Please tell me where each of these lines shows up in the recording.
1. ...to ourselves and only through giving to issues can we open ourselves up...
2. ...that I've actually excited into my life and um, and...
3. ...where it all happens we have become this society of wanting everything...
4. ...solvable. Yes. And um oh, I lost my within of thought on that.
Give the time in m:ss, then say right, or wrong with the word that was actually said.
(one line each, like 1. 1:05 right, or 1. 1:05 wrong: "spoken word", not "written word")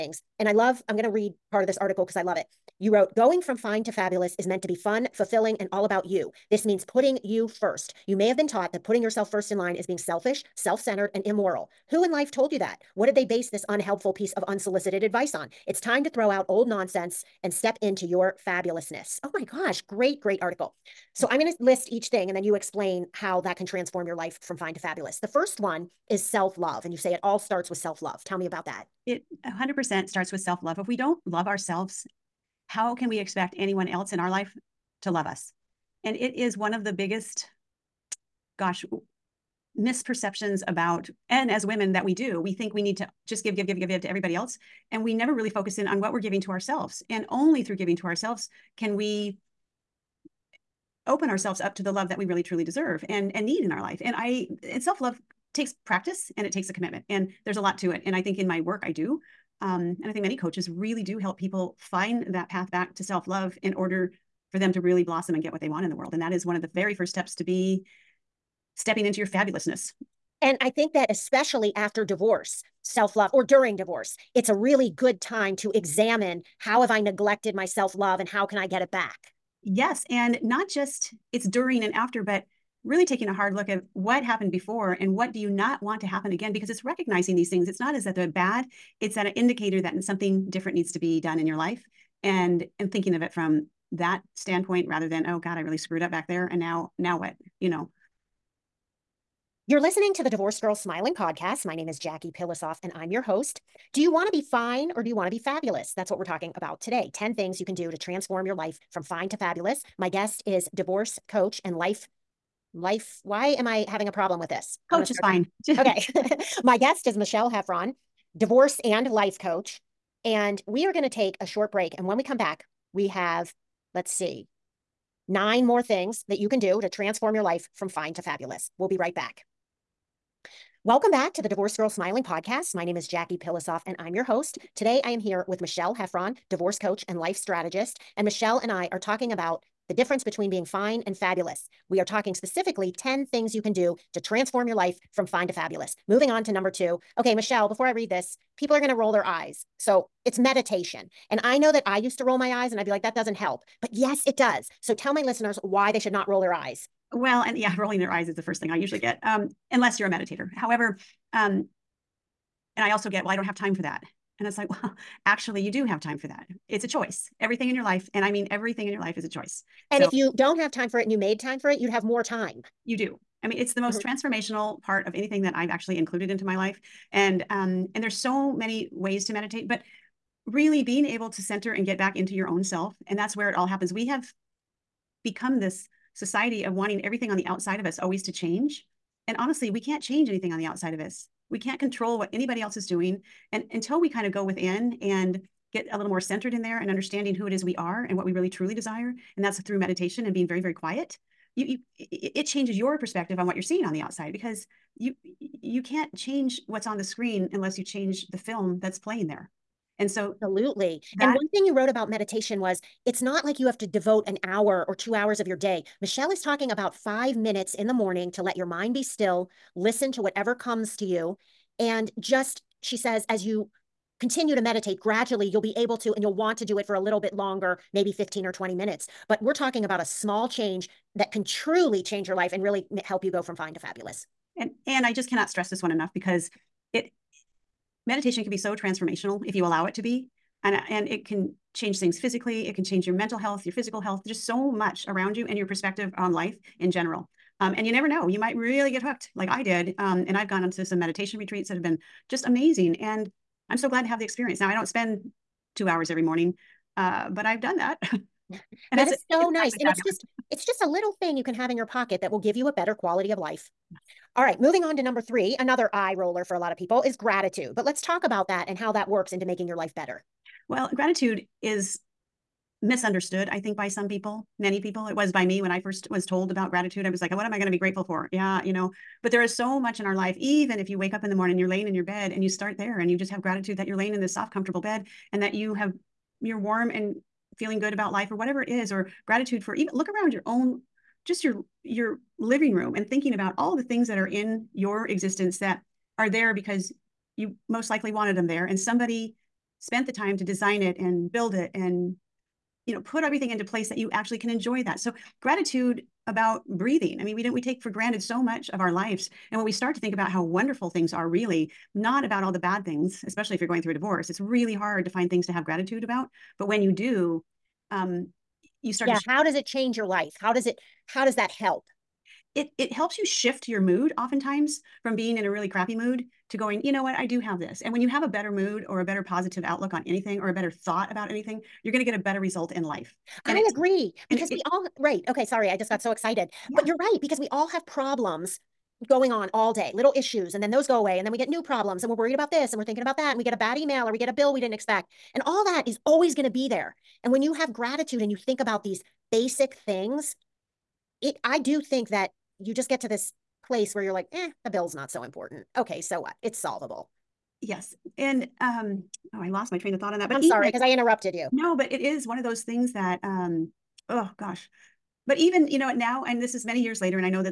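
1. 0:46 wrong: "ourselves", not "issues"
2. 2:55 wrong: "included", not "excited"
3. 3:03 right
4. 5:56 wrong: "train", not "within".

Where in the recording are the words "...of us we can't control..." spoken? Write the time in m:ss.
3:10.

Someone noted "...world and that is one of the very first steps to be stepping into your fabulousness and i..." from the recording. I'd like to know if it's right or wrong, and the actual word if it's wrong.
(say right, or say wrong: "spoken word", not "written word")
right.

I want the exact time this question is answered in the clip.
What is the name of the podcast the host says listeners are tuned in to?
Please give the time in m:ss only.
1:40.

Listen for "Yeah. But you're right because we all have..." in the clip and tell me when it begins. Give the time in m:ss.
5:36.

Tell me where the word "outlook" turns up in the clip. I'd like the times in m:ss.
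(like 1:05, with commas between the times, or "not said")
5:29.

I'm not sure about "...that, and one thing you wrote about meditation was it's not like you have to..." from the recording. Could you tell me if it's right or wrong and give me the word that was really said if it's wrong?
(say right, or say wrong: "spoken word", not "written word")
right.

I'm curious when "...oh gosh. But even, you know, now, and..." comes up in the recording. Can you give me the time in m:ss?
6:04.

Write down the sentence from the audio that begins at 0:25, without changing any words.
The first one is self love.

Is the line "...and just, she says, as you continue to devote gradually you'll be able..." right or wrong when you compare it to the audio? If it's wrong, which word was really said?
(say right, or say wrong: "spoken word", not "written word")
wrong: "meditate", not "devote".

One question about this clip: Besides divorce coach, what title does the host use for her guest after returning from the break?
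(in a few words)
life strategist.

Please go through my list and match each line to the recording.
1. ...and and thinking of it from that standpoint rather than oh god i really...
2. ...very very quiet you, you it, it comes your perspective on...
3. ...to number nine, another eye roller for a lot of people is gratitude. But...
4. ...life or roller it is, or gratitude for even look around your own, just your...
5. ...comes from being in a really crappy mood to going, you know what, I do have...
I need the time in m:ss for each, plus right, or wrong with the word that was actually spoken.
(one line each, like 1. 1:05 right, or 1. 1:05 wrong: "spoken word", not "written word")
1. 1:32 right
2. 3:20 wrong: "changes", not "comes"
3. 4:24 wrong: "three", not "nine"
4. 4:48 wrong: "whatever", not "roller"
5. 5:24 wrong: "oftentimes", not "comes".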